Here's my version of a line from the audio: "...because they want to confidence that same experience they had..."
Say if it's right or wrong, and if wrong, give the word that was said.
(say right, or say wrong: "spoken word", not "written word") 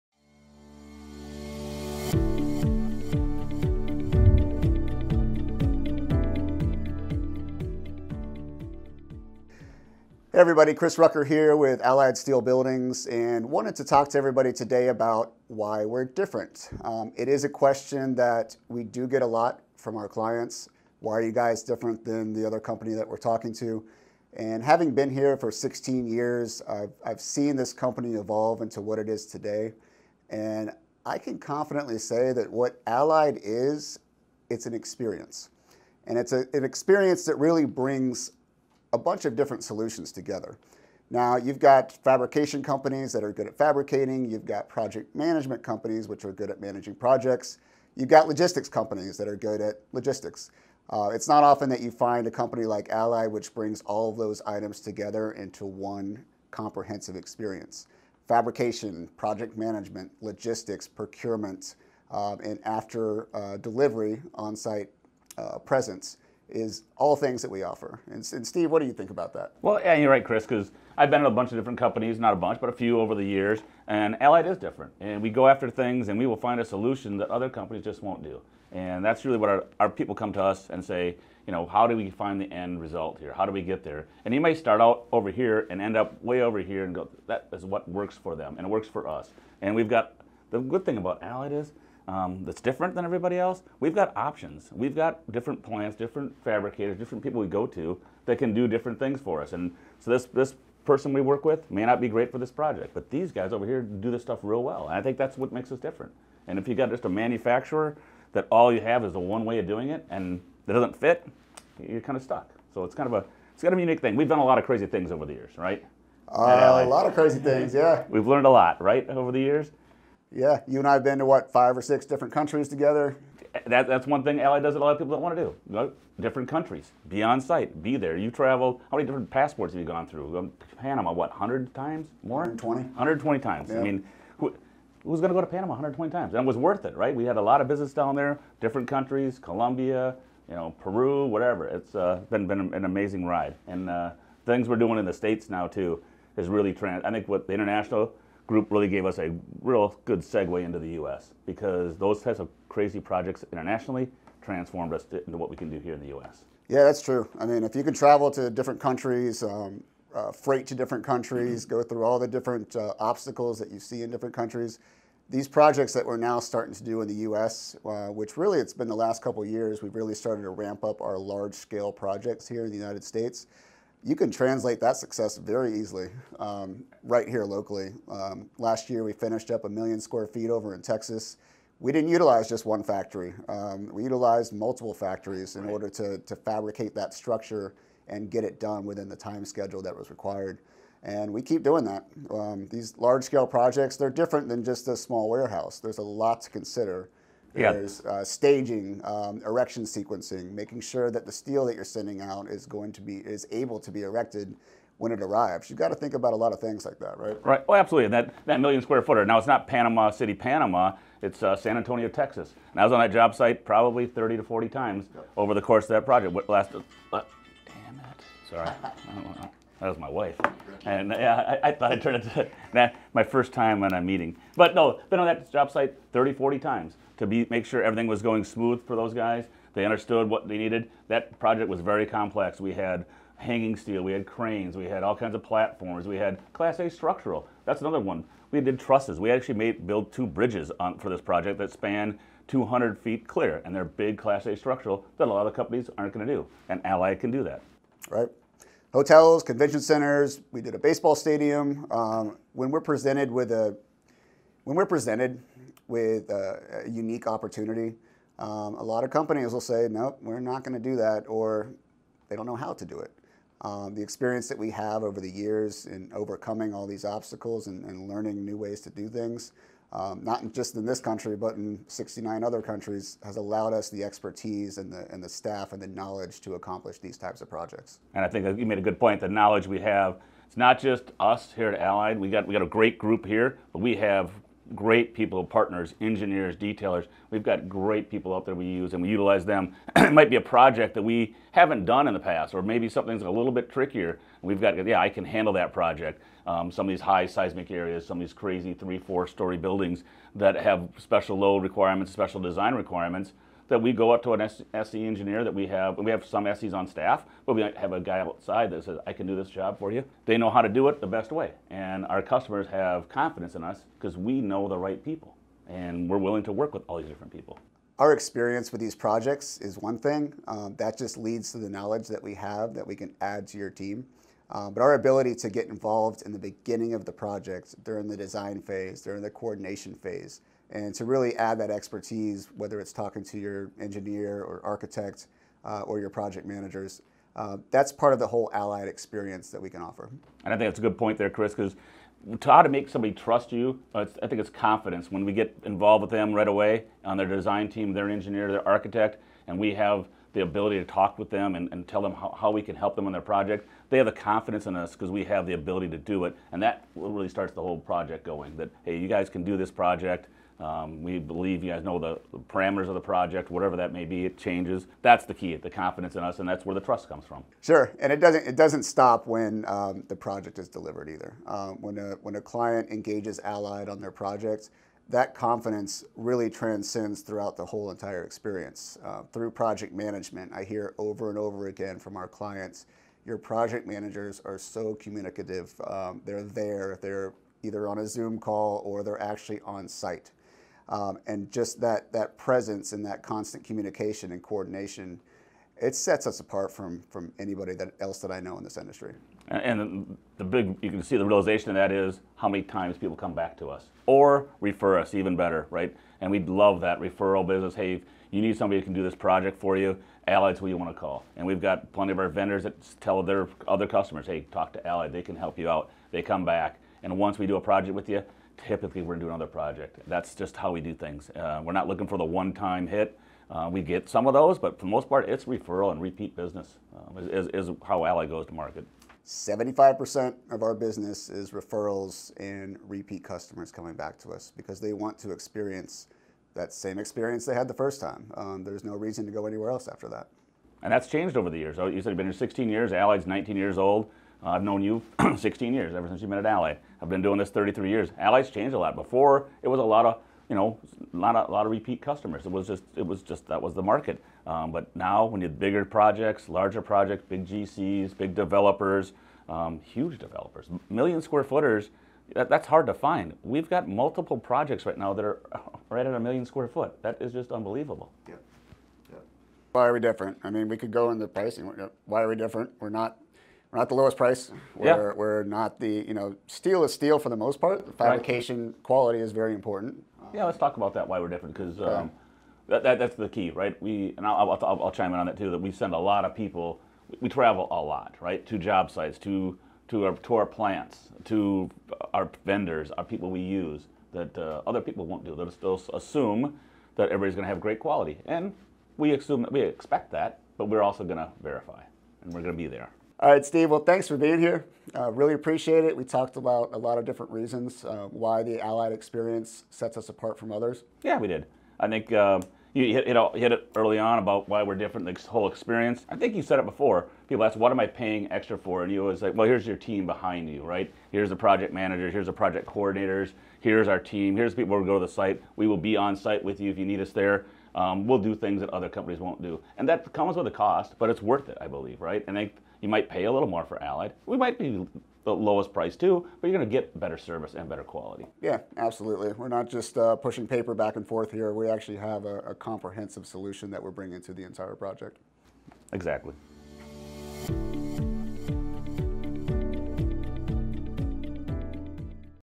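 wrong: "experience", not "confidence".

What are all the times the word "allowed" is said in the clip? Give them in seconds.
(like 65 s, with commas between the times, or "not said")
273 s.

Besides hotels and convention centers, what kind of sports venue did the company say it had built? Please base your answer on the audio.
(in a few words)
baseball stadium.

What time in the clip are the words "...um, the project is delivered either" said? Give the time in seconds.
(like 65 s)
369 s.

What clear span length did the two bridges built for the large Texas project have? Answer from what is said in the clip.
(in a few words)
200 feet.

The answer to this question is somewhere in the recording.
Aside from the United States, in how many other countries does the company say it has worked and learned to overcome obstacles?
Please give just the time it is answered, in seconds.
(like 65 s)
271 s.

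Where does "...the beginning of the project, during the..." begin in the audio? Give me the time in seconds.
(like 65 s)
326 s.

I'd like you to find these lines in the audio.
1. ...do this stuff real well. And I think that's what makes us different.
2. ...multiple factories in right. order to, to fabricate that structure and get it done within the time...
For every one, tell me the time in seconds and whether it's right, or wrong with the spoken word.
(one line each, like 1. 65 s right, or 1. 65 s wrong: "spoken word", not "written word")
1. 103 s right
2. 184 s right.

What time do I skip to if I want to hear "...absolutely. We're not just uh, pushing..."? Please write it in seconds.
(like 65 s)
538 s.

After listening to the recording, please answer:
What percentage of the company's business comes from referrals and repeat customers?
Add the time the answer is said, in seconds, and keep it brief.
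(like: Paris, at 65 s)
75%, at 429 s.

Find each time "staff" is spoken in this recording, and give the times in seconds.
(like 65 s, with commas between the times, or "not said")
275 s, 306 s.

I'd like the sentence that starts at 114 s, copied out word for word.
We've done a lot of crazy things over the years, right?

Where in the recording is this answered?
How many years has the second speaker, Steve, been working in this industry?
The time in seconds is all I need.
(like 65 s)
447 s.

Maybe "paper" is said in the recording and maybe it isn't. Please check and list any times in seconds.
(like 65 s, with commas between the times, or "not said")
540 s.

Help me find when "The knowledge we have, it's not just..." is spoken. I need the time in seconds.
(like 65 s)
279 s.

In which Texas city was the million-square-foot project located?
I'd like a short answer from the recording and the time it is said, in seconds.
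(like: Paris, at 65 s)
San Antonio, at 211 s.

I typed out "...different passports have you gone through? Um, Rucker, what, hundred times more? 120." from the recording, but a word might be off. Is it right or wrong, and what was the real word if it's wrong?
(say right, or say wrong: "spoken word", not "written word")
wrong: "Panama", not "Rucker".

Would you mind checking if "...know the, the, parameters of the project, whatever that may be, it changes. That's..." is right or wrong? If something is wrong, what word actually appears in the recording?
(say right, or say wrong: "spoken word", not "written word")
right.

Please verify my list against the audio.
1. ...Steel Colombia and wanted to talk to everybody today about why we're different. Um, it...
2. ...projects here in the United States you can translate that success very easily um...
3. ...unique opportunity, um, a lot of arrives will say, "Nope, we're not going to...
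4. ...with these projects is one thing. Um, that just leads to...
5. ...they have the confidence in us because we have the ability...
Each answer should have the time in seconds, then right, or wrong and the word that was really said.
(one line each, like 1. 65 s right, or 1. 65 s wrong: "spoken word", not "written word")
1. 12 s wrong: "Buildings", not "Colombia"
2. 171 s right
3. 256 s wrong: "companies", not "arrives"
4. 318 s right
5. 353 s right.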